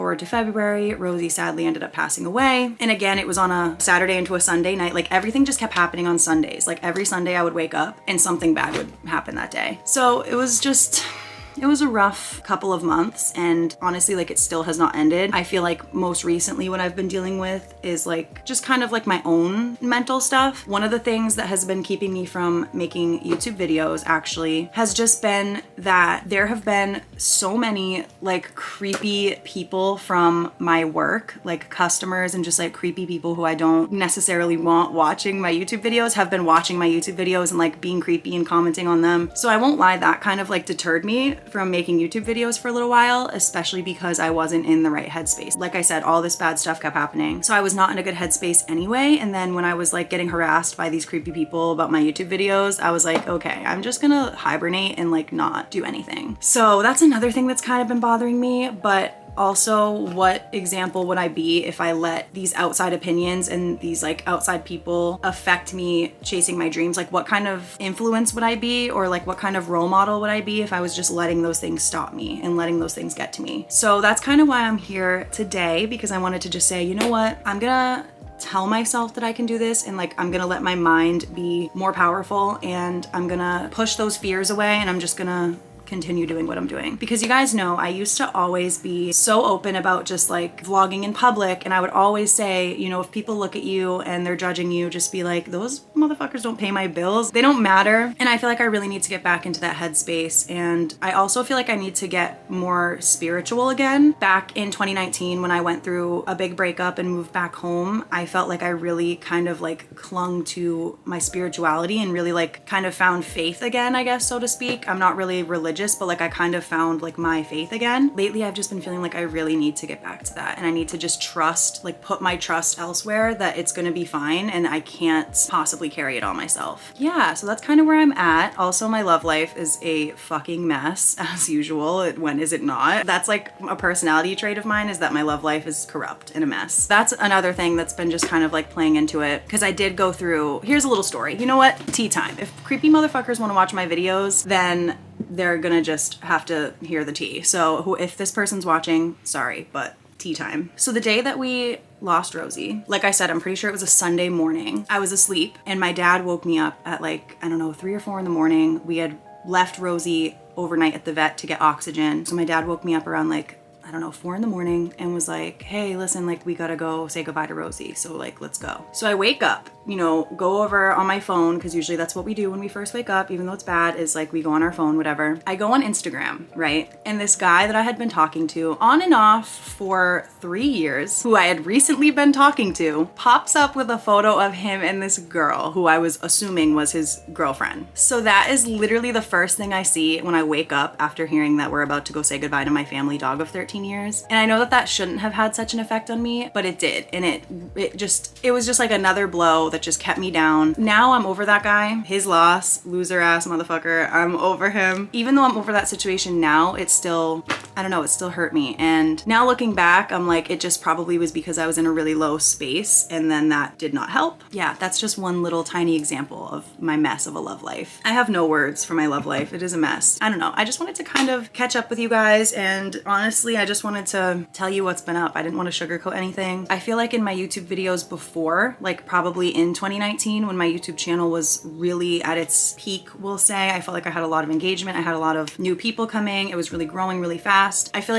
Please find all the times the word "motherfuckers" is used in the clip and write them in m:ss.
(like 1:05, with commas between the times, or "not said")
1:35, 2:22, 3:23.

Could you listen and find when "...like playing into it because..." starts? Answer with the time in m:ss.
2:18.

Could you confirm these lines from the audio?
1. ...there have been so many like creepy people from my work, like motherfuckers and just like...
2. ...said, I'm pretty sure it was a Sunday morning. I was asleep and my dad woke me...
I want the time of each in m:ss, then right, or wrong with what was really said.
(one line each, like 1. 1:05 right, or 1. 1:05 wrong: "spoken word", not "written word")
1. 0:26 wrong: "customers", not "motherfuckers"
2. 2:33 right.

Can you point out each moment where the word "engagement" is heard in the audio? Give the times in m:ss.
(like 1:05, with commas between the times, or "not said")
3:54.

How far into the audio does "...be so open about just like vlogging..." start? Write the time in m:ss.
1:28.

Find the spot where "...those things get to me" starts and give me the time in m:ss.
1:12.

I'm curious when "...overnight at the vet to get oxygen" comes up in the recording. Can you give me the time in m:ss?
2:40.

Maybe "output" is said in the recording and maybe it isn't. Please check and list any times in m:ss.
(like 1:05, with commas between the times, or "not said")
not said.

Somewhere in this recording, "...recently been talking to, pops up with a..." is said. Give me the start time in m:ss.
3:01.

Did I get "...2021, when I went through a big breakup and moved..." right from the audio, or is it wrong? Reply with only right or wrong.
wrong.